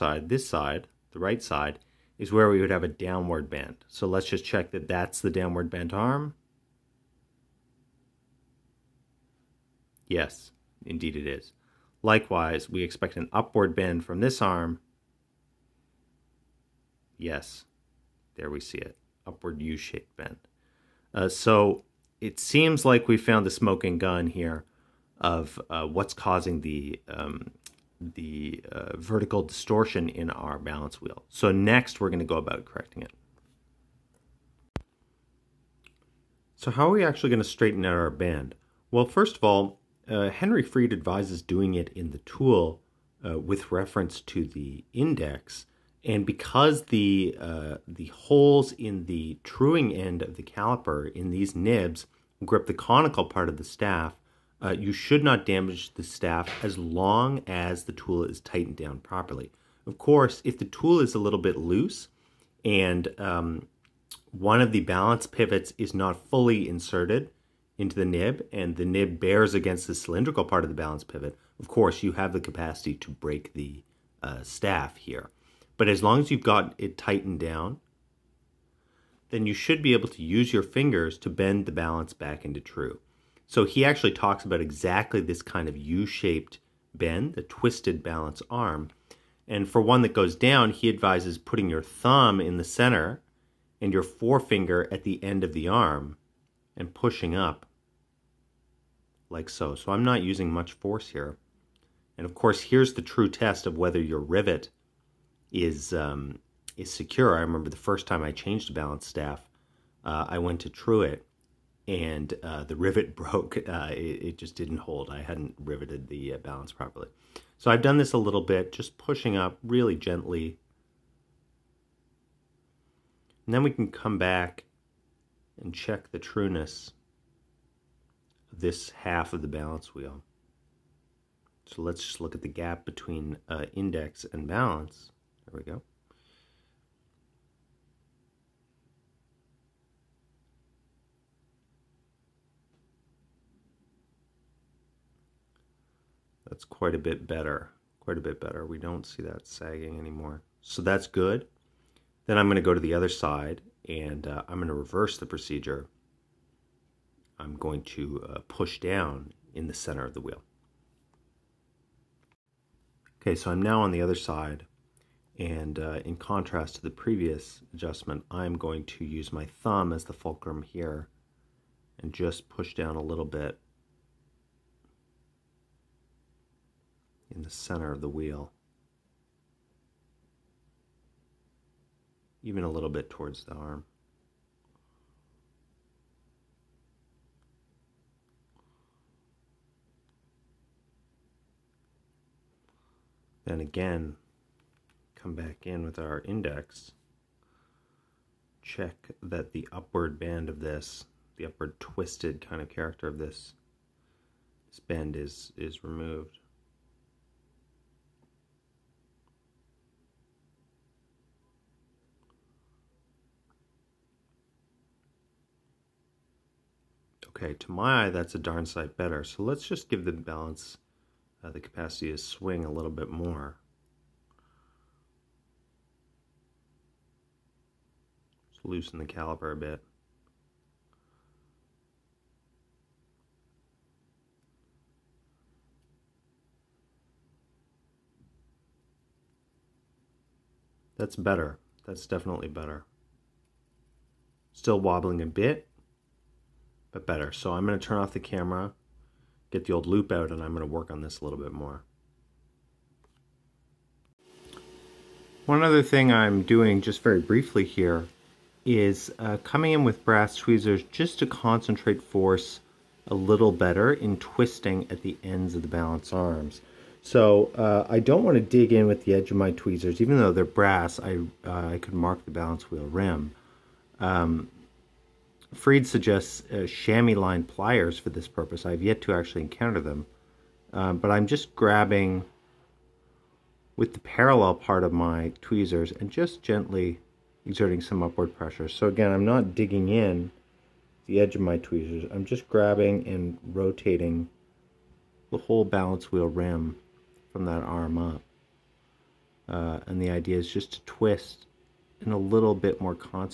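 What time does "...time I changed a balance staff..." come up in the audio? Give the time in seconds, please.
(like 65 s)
108 s.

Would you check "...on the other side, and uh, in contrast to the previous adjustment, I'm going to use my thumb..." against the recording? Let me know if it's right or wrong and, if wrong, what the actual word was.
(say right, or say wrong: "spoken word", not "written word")
right.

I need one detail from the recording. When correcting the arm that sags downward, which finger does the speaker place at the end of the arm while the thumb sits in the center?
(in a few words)
forefinger.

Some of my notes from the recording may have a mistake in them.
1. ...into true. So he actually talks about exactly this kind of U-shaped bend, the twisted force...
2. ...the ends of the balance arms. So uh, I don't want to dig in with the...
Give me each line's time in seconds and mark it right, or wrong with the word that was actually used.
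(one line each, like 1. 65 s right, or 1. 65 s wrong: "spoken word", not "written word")
1. 82 s wrong: "balance", not "force"
2. 265 s right.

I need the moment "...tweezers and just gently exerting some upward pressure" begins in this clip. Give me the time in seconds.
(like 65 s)
285 s.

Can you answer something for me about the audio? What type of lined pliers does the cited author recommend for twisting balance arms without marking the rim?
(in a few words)
chamois lined pliers.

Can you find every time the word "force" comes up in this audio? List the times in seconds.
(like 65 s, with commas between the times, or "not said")
100 s, 262 s.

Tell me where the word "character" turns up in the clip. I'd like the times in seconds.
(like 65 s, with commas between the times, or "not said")
202 s.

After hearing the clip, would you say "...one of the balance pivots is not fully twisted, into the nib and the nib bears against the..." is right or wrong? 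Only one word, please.
wrong.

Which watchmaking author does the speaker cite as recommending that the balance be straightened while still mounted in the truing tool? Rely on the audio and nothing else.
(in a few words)
Henry Fried.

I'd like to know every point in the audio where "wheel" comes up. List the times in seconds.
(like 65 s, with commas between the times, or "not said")
31 s, 129 s, 160 s, 178 s, 272 s, 296 s.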